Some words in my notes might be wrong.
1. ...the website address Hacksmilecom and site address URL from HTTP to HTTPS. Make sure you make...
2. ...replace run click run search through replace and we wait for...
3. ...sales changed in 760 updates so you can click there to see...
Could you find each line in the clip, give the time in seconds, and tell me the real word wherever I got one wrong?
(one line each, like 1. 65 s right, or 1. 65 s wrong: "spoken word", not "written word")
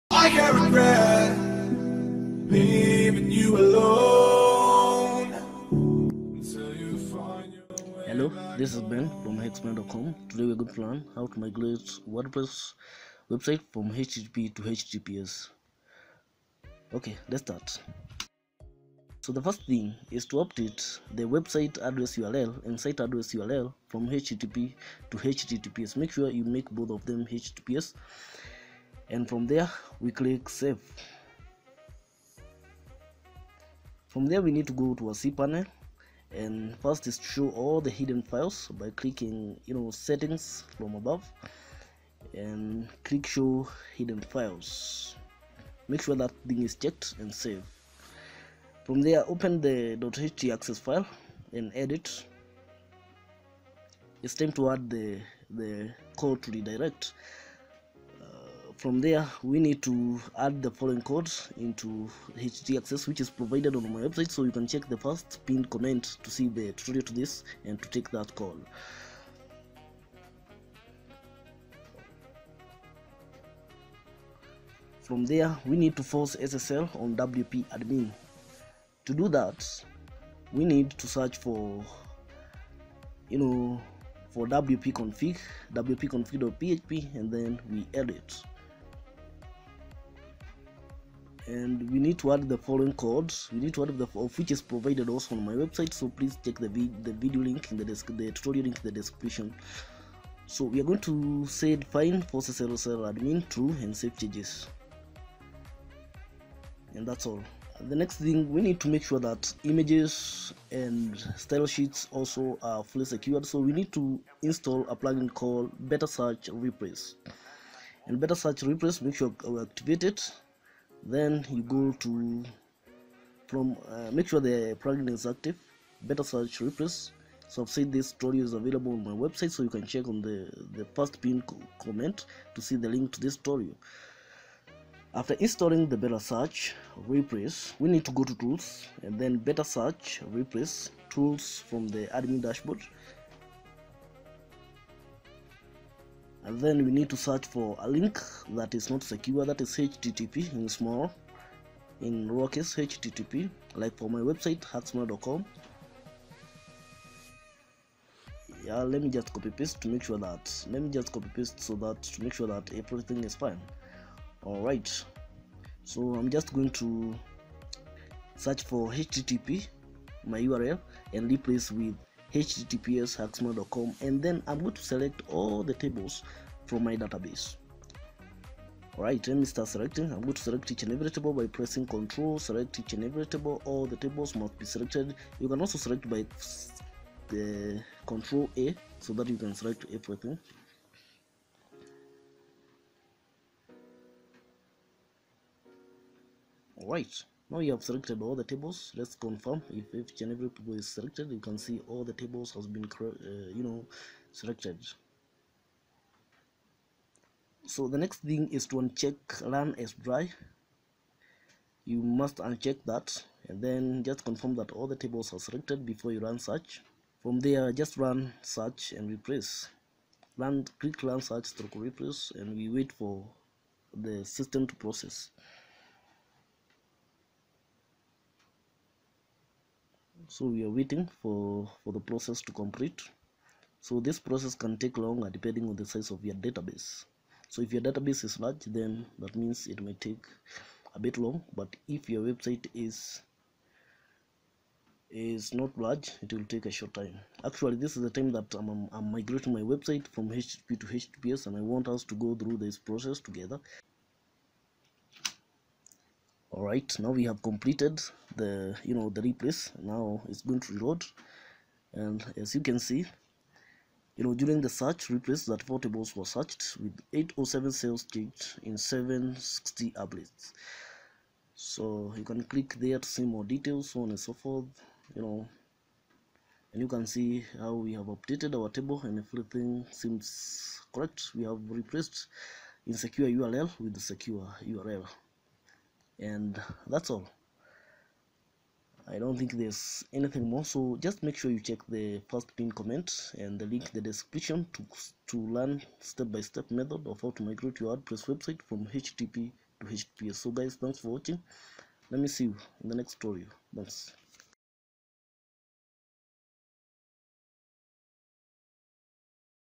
1. 21 s wrong: "URL", not "Hacksmilecom"
2. 219 s right
3. 267 s right.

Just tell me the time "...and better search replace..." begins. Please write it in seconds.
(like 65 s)
118 s.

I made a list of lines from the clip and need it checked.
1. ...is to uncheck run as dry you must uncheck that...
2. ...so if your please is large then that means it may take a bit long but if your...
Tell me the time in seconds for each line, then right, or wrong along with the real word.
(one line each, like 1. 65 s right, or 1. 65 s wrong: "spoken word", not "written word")
1. 208 s right
2. 237 s wrong: "database", not "please".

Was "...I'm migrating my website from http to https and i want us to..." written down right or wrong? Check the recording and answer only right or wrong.
right.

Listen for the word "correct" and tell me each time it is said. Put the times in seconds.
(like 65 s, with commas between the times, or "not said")
280 s.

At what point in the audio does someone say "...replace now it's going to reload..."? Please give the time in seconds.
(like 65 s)
259 s.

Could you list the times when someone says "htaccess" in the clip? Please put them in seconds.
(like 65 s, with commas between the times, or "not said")
49 s, 62 s.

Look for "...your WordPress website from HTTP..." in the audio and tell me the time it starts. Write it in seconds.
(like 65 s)
297 s.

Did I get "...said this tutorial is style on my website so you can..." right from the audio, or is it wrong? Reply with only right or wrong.
wrong.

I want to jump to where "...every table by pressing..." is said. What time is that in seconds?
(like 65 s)
180 s.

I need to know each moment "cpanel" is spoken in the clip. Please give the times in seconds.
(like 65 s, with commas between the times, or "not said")
35 s.